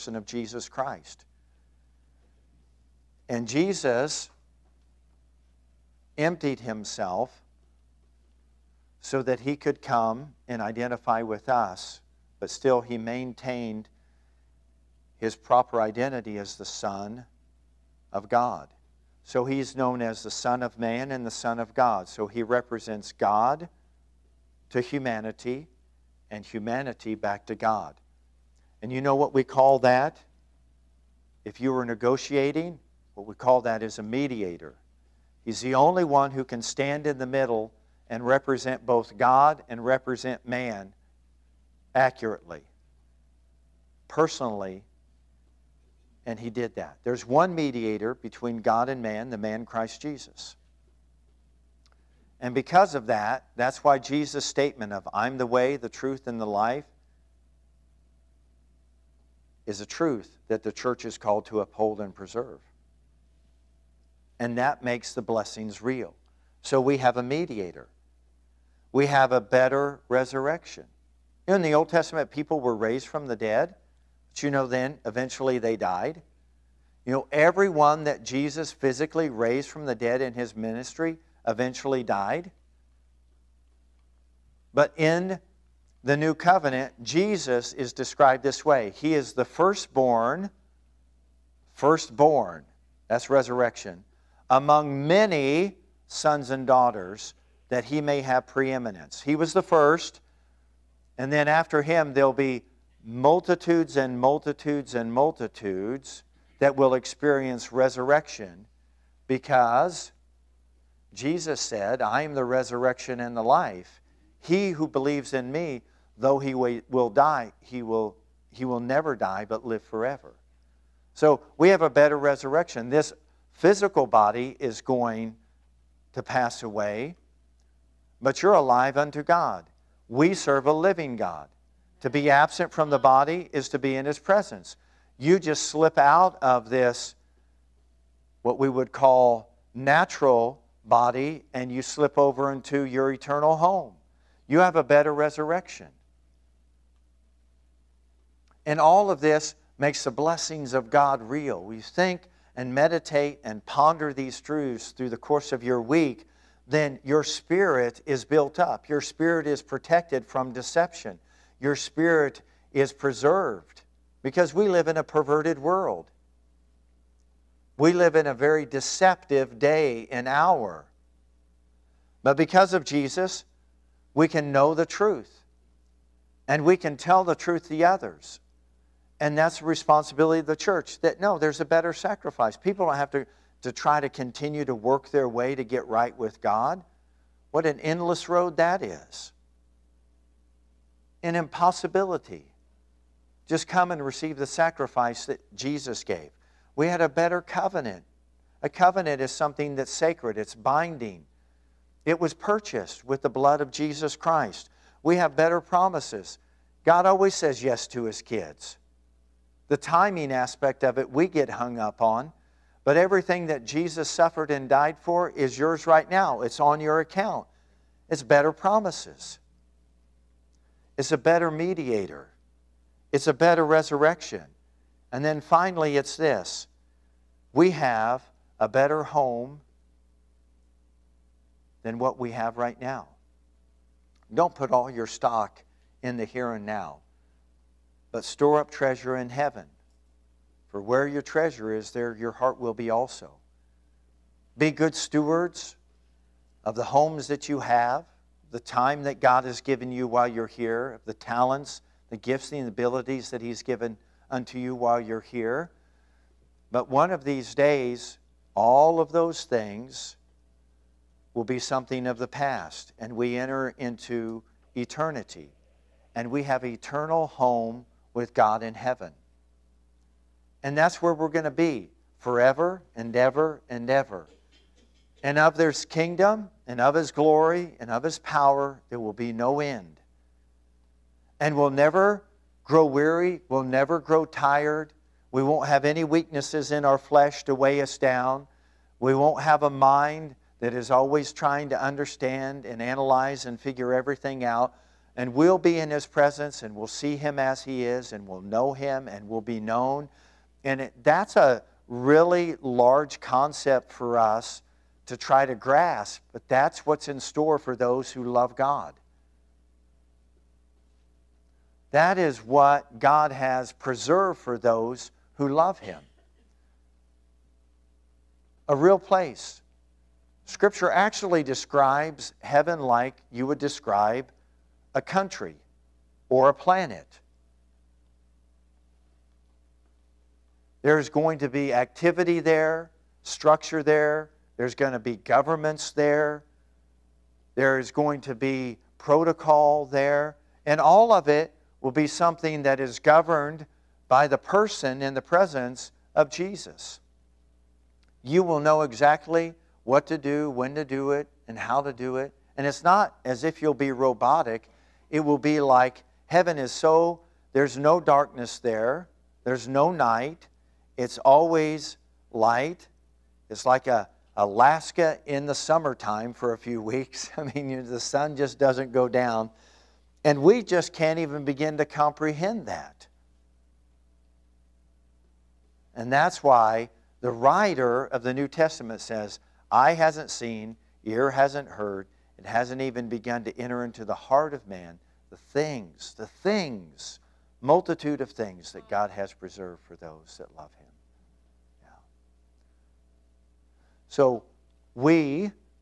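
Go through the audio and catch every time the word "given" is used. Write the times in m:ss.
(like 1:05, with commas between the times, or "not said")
4:09, 4:13.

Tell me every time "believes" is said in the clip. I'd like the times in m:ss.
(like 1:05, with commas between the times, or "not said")
1:54.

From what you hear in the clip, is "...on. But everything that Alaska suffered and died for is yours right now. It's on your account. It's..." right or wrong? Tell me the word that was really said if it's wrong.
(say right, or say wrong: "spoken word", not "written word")
wrong: "Jesus", not "Alaska".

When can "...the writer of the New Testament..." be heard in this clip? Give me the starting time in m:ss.
6:17.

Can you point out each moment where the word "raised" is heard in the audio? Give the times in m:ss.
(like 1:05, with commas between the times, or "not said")
1:12, 1:19.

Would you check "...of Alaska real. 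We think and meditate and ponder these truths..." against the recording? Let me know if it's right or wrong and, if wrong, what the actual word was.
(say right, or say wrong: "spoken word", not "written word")
wrong: "God", not "Alaska".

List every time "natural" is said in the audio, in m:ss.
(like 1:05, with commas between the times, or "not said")
2:19.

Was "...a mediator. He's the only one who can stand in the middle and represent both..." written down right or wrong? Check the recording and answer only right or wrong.
right.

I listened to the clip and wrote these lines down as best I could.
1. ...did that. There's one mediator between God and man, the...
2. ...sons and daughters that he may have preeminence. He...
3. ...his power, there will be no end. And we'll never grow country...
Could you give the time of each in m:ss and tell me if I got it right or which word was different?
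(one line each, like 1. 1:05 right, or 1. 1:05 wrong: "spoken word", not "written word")
1. 0:46 right
2. 1:36 right
3. 4:38 wrong: "weary", not "country".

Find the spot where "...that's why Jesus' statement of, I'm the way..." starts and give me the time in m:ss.
0:53.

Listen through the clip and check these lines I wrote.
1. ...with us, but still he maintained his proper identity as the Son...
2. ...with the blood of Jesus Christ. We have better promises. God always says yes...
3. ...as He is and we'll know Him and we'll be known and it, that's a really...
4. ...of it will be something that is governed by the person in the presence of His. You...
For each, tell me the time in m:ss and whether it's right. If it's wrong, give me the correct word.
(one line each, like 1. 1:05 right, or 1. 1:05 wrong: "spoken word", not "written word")
1. 0:11 right
2. 3:23 right
3. 4:57 right
4. 5:41 wrong: "Jesus", not "His".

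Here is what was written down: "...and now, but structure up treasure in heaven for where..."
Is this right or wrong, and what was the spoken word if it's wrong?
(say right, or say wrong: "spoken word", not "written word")
wrong: "store", not "structure".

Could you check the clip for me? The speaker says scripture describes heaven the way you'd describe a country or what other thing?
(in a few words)
a planet.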